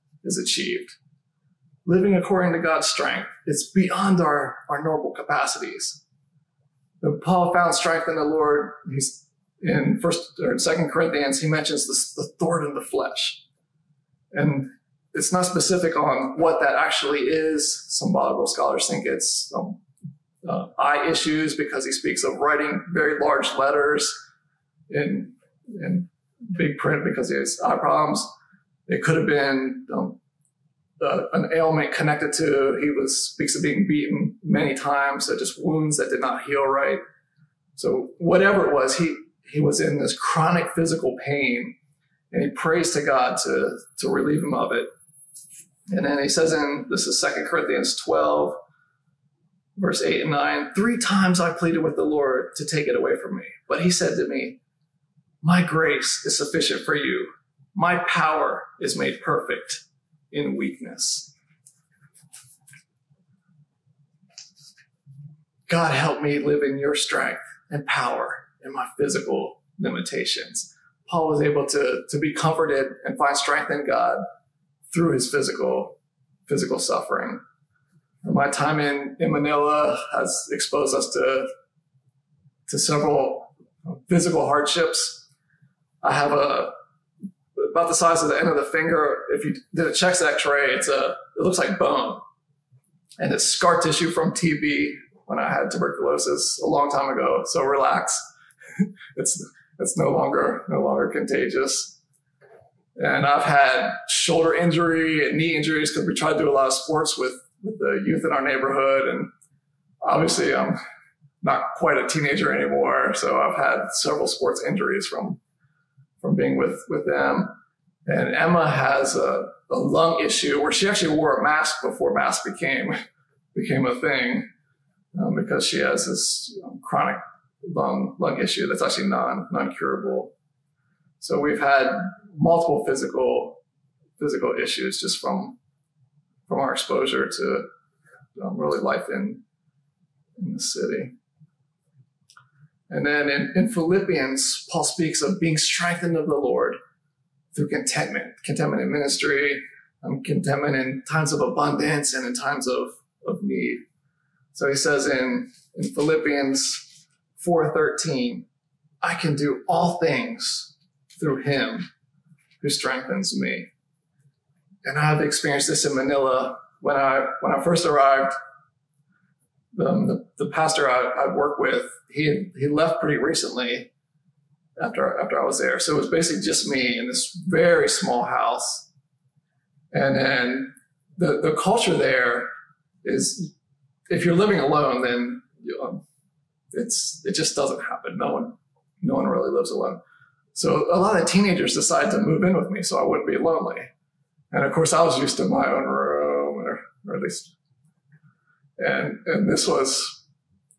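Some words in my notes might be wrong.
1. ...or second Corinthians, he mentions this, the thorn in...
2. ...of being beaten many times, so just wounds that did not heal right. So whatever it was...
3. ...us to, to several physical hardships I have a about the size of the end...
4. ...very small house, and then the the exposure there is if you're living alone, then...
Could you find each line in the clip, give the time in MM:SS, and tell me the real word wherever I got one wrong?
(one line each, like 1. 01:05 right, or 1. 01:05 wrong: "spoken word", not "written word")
1. 00:10 right
2. 00:33 right
3. 01:20 right
4. 02:57 wrong: "culture", not "exposure".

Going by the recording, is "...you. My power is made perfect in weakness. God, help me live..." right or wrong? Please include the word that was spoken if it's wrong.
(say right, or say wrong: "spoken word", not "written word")
right.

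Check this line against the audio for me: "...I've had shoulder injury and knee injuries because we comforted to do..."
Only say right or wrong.
wrong.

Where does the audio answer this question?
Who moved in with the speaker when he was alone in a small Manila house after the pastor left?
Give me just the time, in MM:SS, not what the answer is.
03:11.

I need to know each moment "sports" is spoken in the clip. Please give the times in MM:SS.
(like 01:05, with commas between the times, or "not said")
01:46, 01:54.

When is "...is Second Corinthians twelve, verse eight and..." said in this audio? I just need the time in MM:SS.
00:47.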